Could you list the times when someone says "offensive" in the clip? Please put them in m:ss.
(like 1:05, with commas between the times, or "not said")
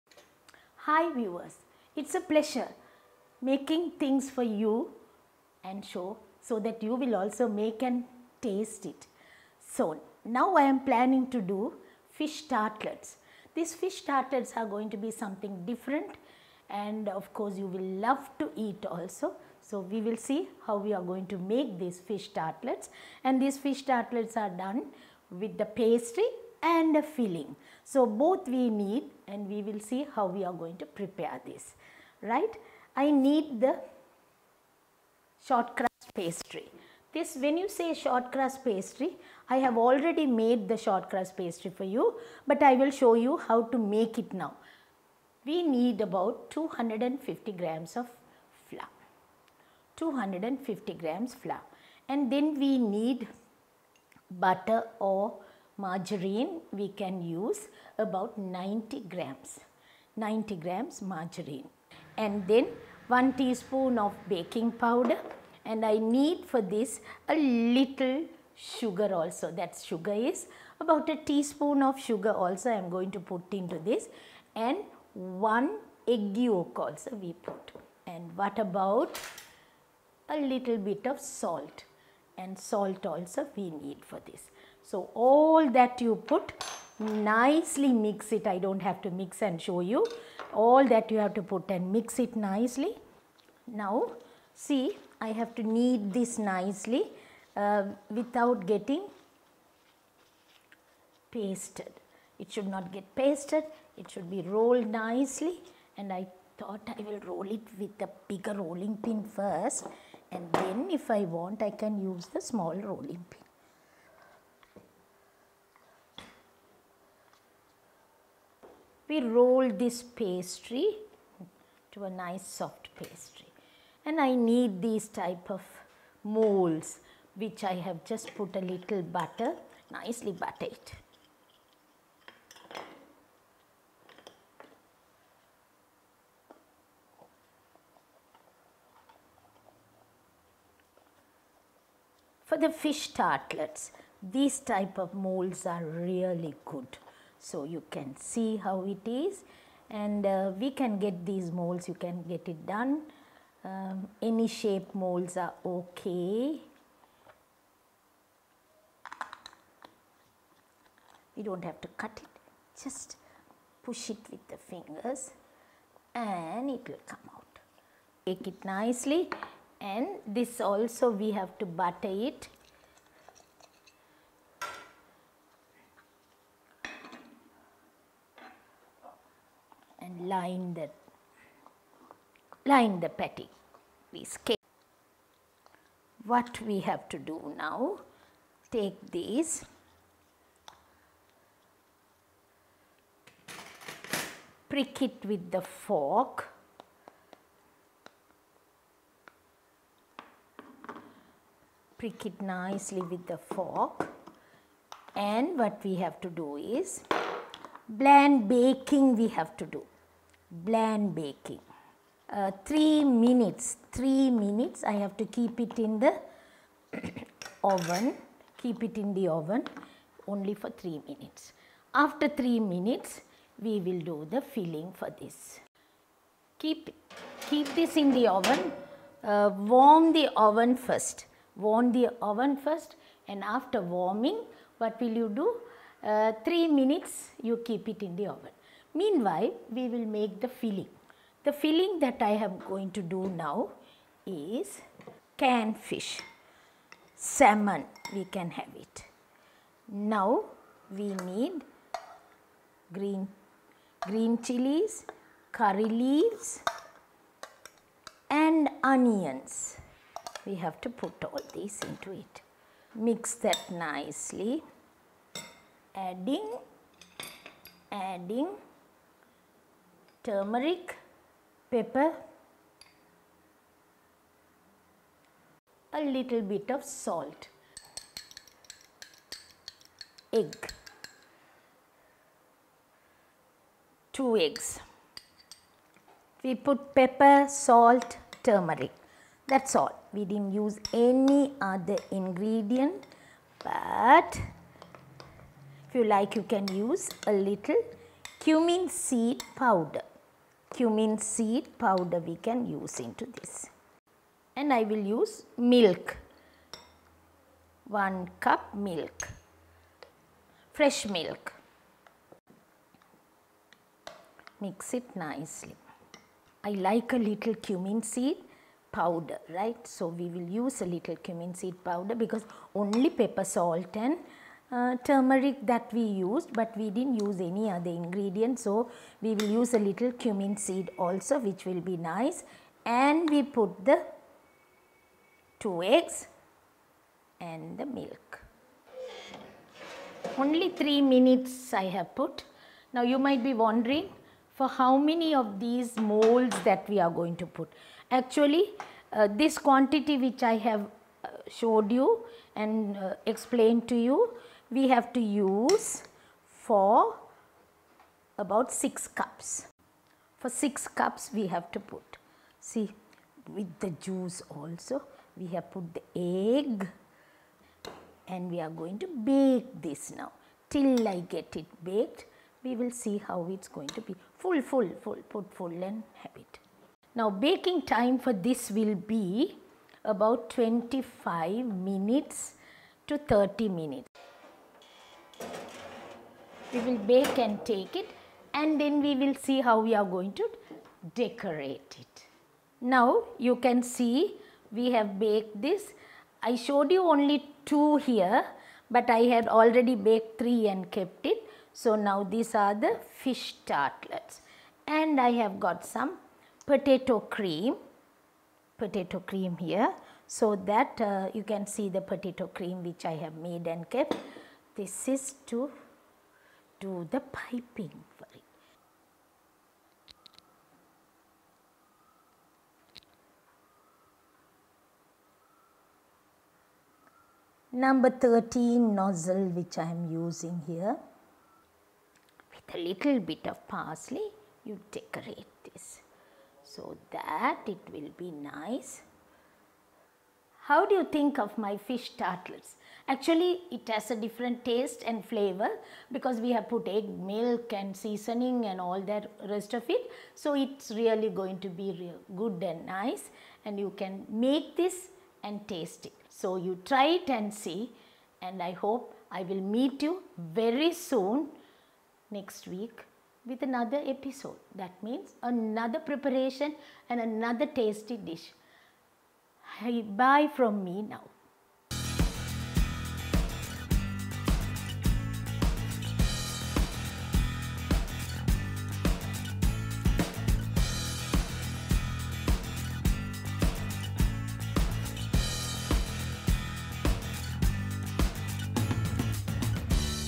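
not said.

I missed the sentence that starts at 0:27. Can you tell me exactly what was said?
So, both we need and we will see how we are going to prepare this, right.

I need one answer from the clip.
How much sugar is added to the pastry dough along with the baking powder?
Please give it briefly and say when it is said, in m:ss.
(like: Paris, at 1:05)
a teaspoon, at 1:11.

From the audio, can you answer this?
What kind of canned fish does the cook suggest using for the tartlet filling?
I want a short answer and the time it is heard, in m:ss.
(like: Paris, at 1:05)
salmon, at 4:07.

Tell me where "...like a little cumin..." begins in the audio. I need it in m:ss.
5:16.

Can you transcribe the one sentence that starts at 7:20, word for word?
How do you think of my fish tartlets?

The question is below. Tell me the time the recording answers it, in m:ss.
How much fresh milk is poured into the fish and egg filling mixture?
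5:07.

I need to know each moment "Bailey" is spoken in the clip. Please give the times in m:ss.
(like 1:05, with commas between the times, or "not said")
not said.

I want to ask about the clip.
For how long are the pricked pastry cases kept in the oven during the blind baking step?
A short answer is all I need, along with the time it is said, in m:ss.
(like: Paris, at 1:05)
3 minutes, at 3:38.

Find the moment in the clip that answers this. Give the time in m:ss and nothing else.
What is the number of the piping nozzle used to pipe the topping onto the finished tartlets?
7:07.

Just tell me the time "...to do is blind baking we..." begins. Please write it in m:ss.
3:26.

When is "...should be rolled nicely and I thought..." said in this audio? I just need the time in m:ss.
1:44.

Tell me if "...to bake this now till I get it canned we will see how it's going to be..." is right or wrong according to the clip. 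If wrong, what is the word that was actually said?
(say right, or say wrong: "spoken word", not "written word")
wrong: "baked", not "canned".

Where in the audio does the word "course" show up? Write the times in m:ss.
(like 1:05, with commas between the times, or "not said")
0:17.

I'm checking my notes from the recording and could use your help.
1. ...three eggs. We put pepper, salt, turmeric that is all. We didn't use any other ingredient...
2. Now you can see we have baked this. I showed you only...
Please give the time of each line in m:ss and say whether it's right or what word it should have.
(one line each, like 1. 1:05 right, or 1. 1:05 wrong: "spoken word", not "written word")
1. 4:44 wrong: "two", not "three"
2. 6:32 right.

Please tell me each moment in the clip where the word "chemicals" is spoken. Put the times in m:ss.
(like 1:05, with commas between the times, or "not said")
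not said.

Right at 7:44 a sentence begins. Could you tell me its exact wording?
That means another preparation and another tasty dish.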